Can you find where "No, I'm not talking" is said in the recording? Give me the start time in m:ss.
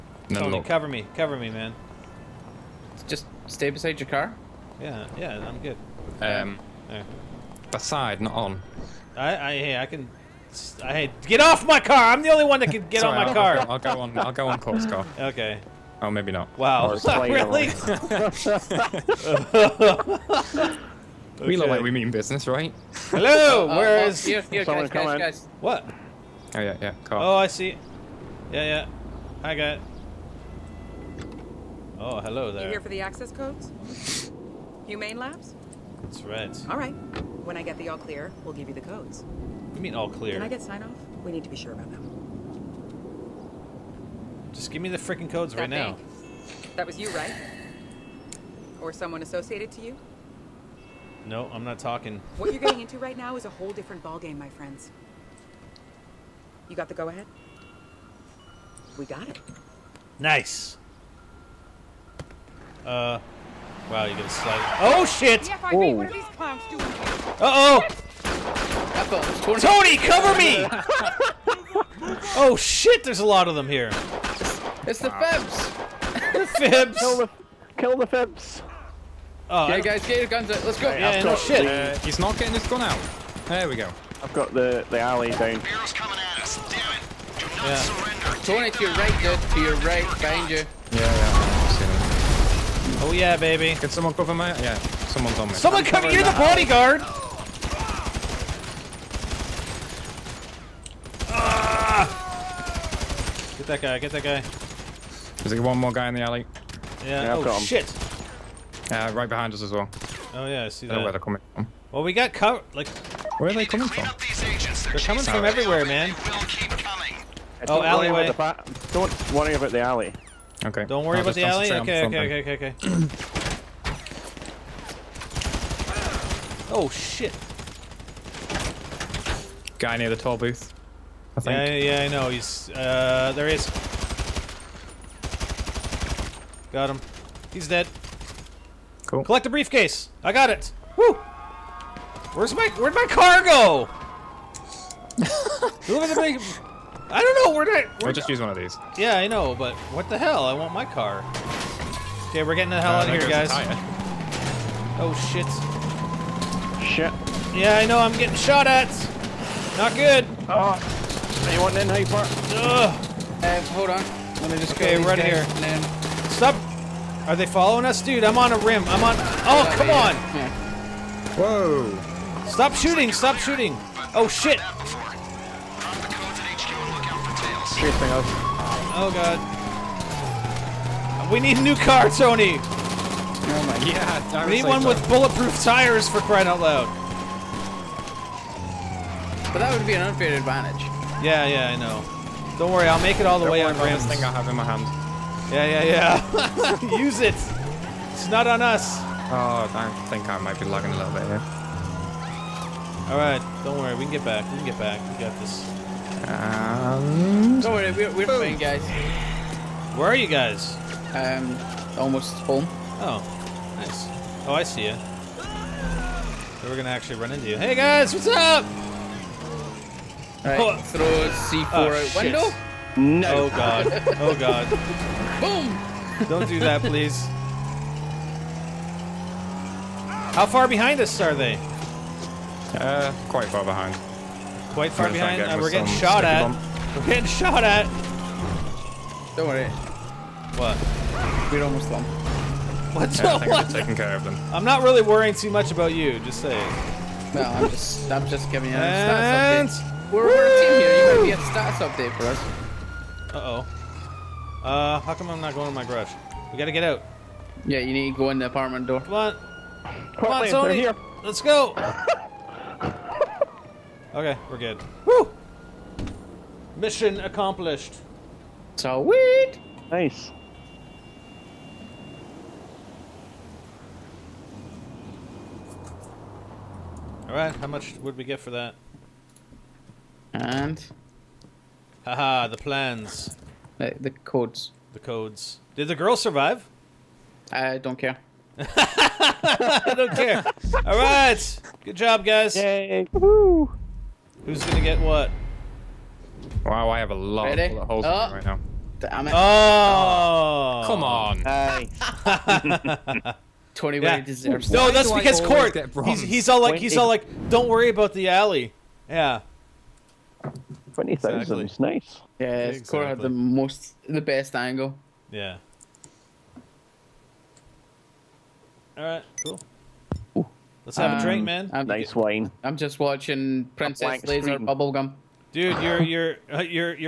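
0:51.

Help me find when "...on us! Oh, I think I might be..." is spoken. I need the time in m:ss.
3:18.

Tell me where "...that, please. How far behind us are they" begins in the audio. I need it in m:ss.
3:46.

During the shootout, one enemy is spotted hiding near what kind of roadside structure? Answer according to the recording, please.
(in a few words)
toll booth.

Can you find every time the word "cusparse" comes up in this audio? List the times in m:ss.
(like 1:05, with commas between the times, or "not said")
not said.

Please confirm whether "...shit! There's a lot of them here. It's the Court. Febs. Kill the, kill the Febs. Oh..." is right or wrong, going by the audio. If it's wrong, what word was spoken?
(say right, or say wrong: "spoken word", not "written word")
wrong: "Febs", not "Court".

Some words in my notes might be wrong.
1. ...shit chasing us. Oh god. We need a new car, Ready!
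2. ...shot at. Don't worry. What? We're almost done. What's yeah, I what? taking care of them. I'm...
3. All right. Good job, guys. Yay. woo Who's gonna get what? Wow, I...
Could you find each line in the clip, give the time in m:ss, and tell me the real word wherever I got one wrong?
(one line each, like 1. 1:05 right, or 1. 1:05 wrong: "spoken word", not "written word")
1. 2:54 wrong: "Tony", not "Ready"
2. 3:57 right
3. 4:50 right.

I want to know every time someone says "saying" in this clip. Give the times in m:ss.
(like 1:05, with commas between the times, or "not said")
4:06.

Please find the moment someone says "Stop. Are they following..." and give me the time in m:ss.
2:46.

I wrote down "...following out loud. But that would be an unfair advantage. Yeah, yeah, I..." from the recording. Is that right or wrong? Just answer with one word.
wrong.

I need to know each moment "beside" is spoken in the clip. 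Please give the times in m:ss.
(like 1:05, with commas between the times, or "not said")
0:03, 0:07.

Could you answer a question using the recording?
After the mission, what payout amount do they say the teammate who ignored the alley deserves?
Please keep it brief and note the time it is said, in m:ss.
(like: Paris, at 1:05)
20,000, at 5:10.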